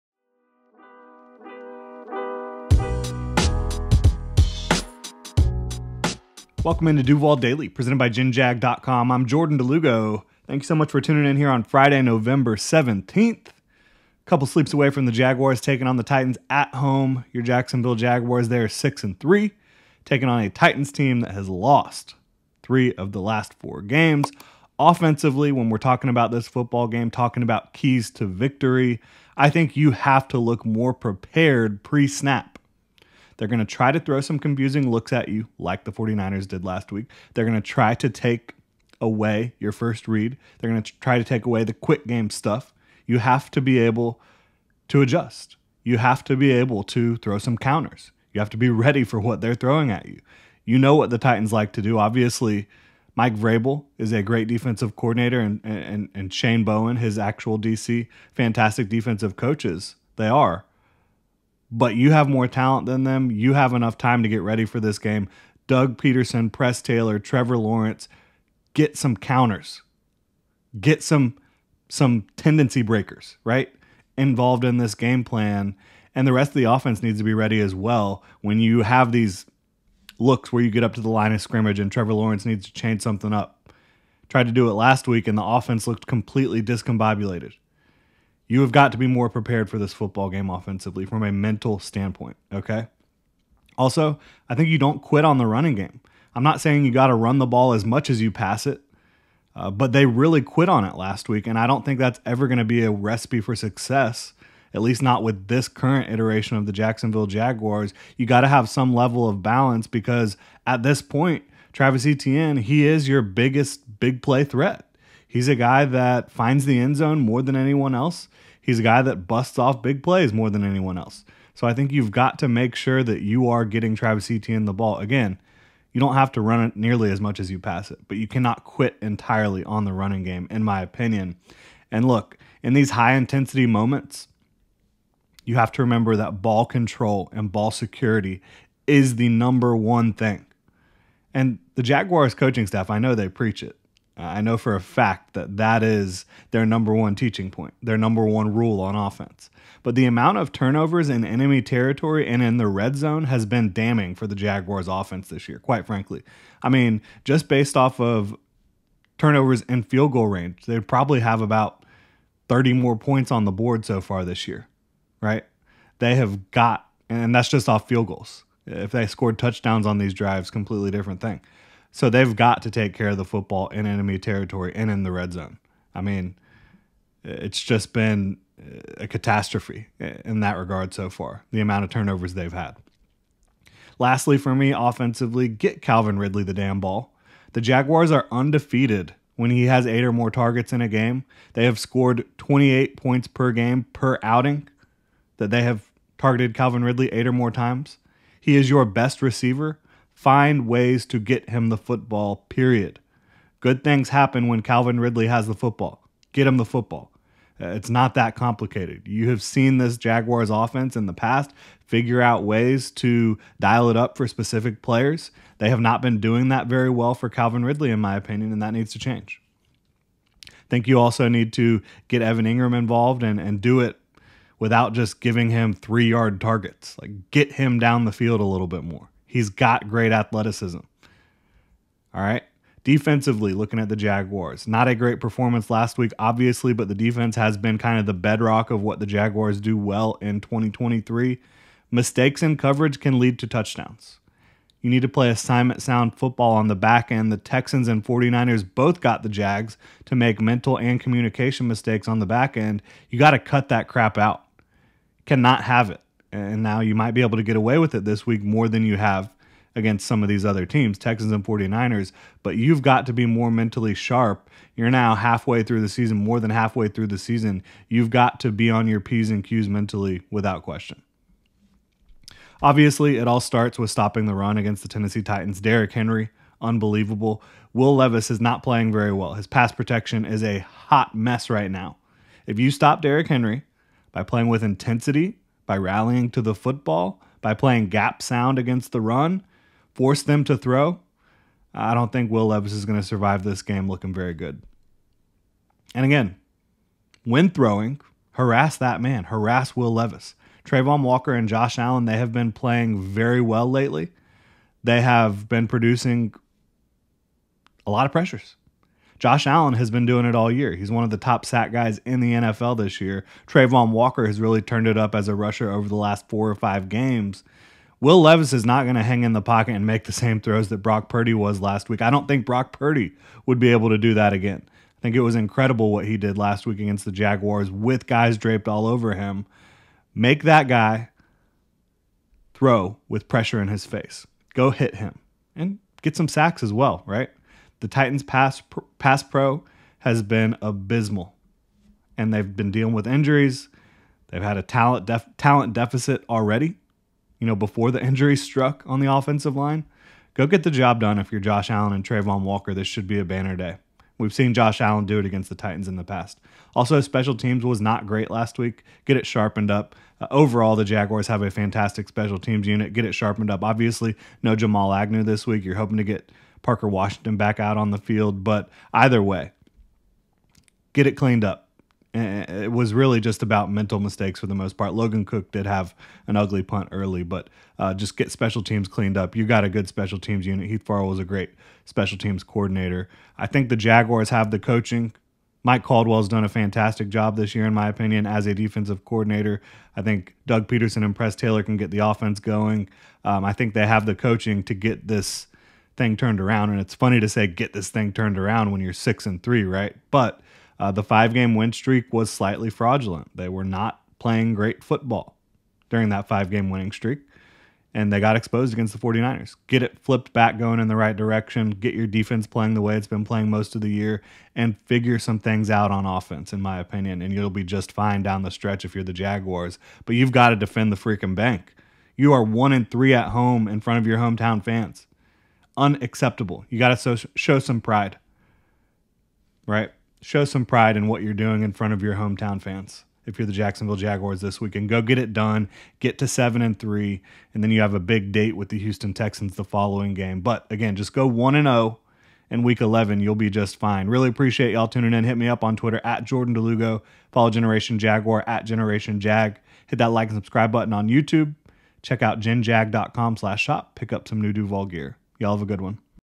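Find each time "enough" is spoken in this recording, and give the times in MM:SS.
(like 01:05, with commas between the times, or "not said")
01:03.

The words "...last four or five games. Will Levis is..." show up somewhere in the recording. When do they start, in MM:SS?
05:15.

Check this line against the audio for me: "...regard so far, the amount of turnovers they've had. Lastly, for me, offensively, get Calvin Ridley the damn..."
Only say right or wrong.
right.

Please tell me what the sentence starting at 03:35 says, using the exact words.
They have not been doing that very well for Calvin Ridley, in my opinion, and that needs to change.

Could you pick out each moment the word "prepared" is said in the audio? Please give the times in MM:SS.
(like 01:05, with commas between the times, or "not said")
00:30, 01:29.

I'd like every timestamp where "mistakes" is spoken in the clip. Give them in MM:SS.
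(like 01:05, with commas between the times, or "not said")
04:01, 04:11, 06:13.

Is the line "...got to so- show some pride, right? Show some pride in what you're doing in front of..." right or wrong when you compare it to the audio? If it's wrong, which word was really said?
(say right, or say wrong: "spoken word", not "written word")
right.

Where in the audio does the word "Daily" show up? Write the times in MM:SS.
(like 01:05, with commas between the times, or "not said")
00:07.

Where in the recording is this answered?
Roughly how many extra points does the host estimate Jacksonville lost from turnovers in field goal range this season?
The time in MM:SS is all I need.
02:42.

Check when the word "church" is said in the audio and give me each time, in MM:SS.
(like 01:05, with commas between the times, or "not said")
not said.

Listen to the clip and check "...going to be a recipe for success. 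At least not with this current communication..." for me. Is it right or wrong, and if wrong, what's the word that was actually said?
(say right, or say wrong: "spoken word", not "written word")
wrong: "iteration", not "communication".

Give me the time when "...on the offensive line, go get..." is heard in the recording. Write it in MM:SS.
05:48.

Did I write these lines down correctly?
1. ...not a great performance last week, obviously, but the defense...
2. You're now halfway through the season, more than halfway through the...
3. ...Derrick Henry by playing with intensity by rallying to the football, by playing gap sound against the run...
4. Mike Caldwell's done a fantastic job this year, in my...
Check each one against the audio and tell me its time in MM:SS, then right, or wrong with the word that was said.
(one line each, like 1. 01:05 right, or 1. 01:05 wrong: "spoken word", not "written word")
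1. 03:54 right
2. 04:24 right
3. 04:43 right
4. 06:25 right.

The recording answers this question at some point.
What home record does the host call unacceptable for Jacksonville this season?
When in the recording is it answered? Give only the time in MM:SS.
07:02.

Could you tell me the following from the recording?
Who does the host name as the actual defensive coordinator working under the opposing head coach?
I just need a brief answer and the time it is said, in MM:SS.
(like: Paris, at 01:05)
Shane Bowen, at 00:56.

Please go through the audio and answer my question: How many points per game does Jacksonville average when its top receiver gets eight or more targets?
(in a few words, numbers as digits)
28.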